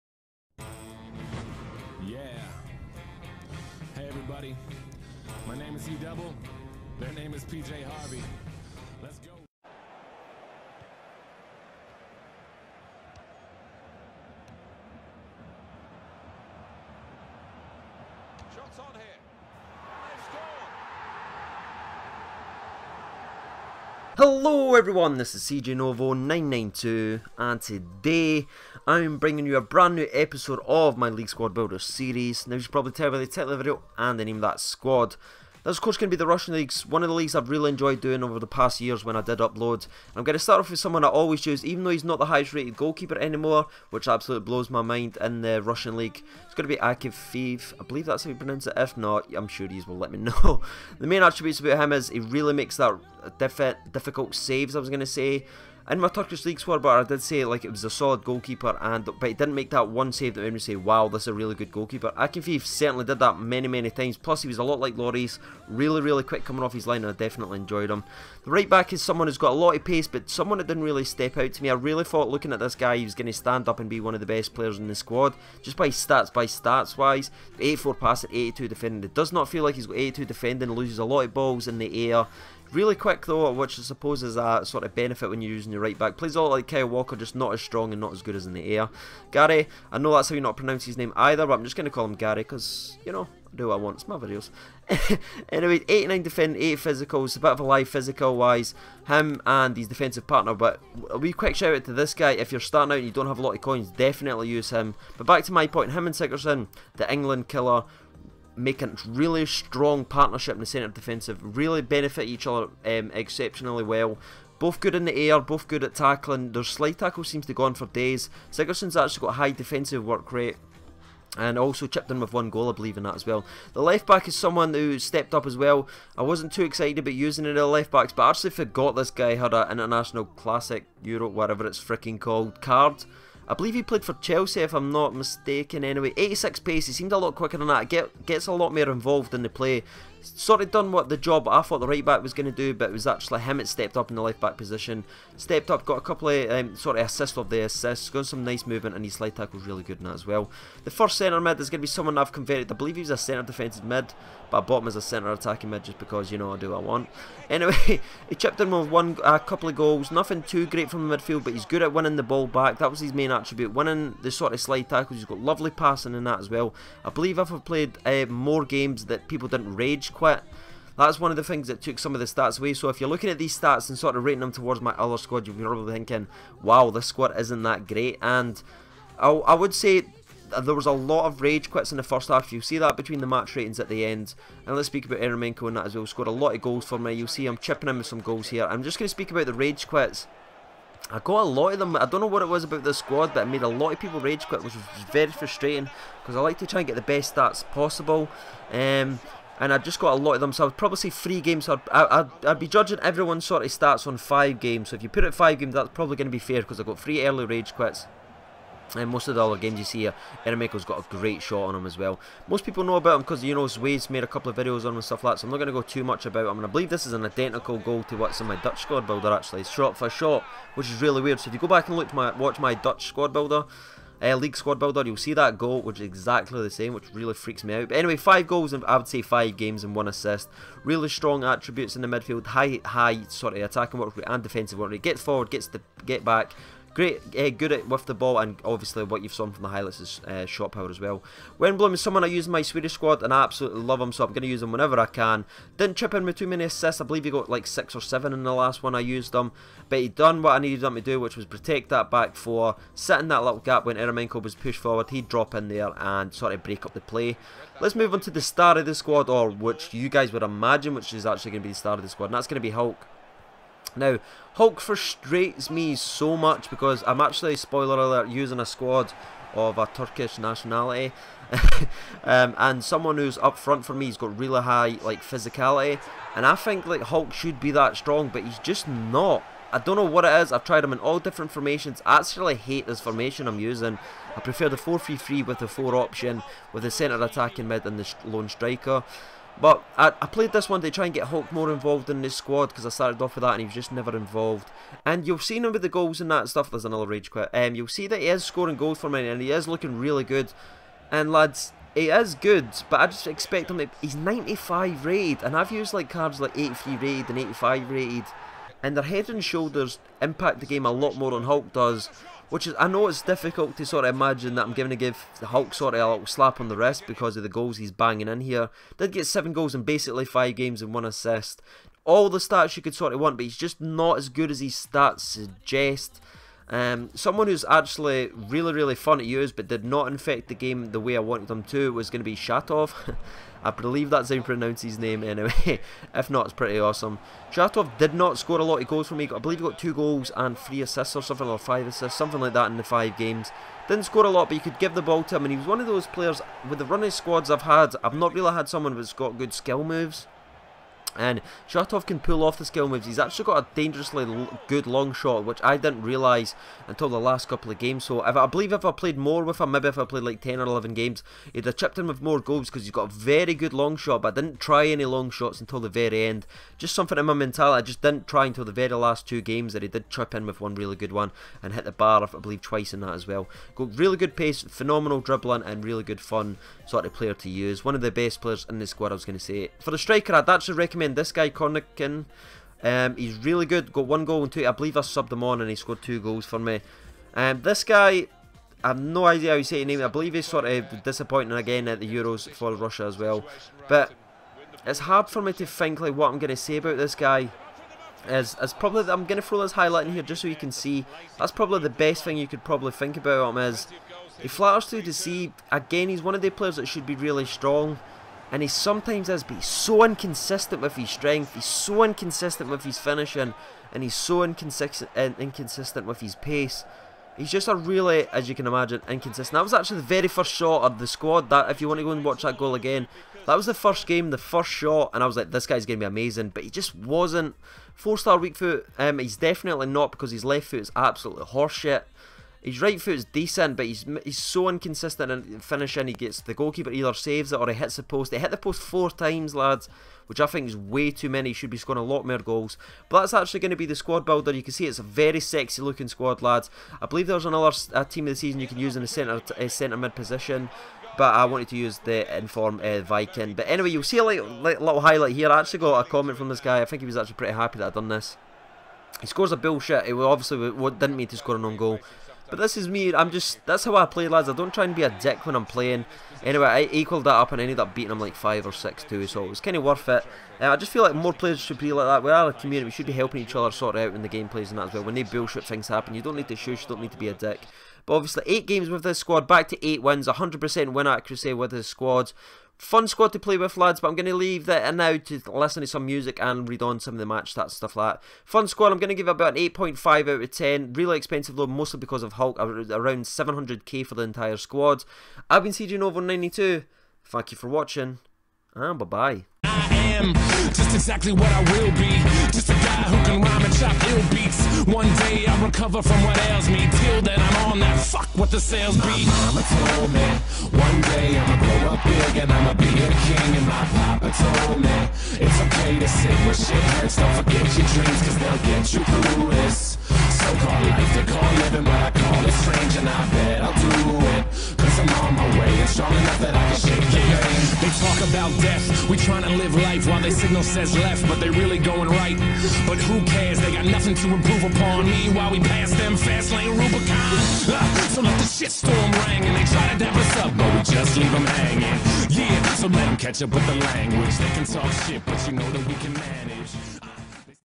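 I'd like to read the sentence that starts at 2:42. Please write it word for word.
That was his main main attribute, winning the sort of slide tackles, he's got lovely passing in that as well.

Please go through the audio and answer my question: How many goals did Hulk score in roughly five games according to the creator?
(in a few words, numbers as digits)
7.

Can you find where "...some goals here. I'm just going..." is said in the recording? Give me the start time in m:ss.
3:08.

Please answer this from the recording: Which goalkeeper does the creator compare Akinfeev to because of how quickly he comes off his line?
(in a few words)
Lloris.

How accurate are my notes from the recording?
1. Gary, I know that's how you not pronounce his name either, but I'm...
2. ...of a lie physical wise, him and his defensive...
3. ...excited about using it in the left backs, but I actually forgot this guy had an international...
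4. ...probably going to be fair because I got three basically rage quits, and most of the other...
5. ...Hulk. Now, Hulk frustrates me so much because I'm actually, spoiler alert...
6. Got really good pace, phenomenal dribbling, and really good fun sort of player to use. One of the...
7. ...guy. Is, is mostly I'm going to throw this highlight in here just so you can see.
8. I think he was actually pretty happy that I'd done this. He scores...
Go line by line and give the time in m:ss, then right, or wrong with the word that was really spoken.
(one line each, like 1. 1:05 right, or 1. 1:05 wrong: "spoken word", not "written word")
1. 1:29 right
2. 1:37 right
3. 2:06 right
4. 3:25 wrong: "early", not "basically"
5. 4:22 right
6. 6:13 right
7. 6:37 wrong: "probably", not "mostly"
8. 7:36 right.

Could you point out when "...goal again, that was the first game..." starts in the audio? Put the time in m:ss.
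7:02.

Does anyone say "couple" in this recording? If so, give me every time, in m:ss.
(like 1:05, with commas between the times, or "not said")
2:26, 2:39, 3:34, 5:57.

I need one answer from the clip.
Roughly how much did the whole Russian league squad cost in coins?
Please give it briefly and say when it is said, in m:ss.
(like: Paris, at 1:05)
700k, at 8:13.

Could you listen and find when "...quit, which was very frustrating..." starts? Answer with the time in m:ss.
3:14.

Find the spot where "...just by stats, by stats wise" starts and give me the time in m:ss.
1:15.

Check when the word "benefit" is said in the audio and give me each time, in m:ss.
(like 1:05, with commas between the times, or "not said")
1:24, 1:51.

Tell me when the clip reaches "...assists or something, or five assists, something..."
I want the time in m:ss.
5:40.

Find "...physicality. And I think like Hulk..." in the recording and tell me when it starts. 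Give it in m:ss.
4:35.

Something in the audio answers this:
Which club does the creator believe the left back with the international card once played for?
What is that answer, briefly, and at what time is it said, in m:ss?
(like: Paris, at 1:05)
Chelsea, at 2:14.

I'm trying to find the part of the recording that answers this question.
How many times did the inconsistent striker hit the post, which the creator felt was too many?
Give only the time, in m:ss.
7:18.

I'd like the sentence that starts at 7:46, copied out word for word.
Anyway, I equalled that up and ended up beating him like 5 or 6 too, so it was kind of worth it.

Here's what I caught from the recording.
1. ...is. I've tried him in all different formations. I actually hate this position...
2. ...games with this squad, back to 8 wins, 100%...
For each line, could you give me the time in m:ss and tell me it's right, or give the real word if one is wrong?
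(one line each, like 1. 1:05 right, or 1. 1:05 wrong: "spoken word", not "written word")
1. 4:40 wrong: "formation", not "position"
2. 7:58 right.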